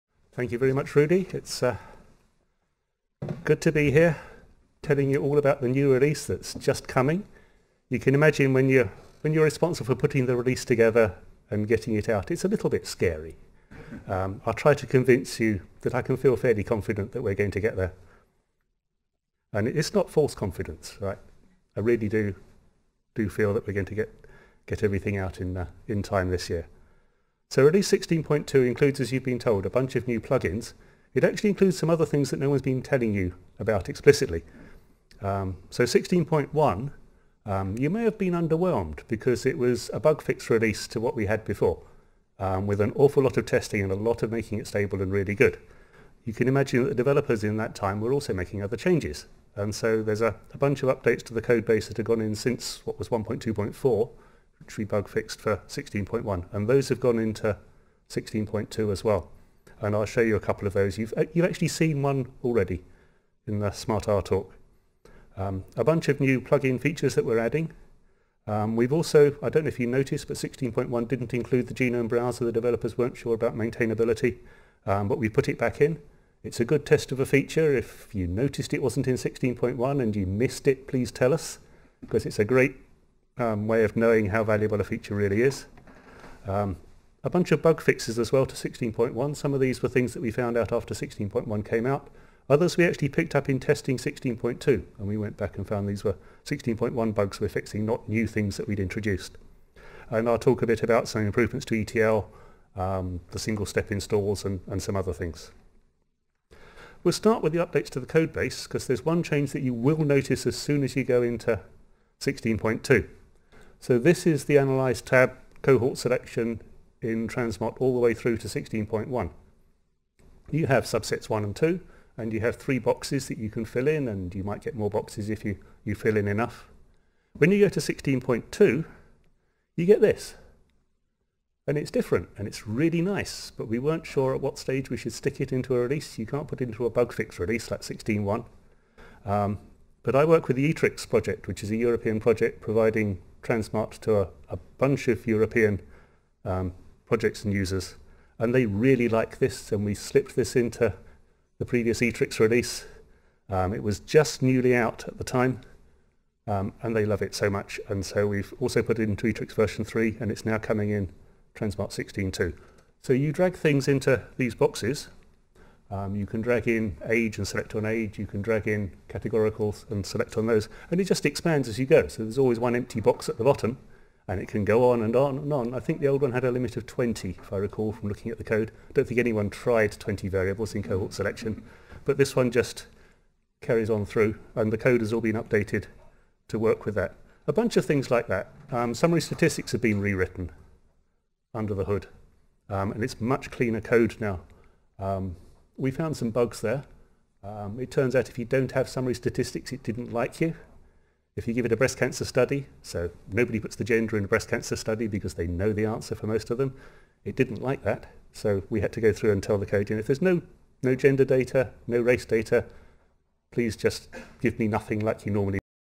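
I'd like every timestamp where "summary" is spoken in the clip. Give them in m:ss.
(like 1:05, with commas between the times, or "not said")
3:08, 3:18.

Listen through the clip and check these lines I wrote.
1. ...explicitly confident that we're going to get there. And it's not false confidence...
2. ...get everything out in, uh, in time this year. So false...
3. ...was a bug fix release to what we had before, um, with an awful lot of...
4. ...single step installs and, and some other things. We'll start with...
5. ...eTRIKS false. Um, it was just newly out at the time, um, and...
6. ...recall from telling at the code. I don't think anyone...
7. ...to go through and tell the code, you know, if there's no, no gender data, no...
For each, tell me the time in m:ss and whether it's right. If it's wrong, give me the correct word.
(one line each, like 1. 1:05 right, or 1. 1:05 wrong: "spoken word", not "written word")
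1. 0:16 wrong: "fairly", not "explicitly"
2. 0:24 wrong: "release", not "false"
3. 0:39 right
4. 1:43 right
5. 2:32 wrong: "release", not "false"
6. 2:57 wrong: "looking", not "telling"
7. 3:28 right.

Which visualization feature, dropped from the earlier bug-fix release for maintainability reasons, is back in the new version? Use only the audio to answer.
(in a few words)
genome browser.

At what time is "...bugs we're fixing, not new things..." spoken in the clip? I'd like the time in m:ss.
1:37.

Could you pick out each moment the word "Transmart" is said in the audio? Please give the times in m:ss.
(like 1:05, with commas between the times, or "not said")
1:57, 2:23, 2:41.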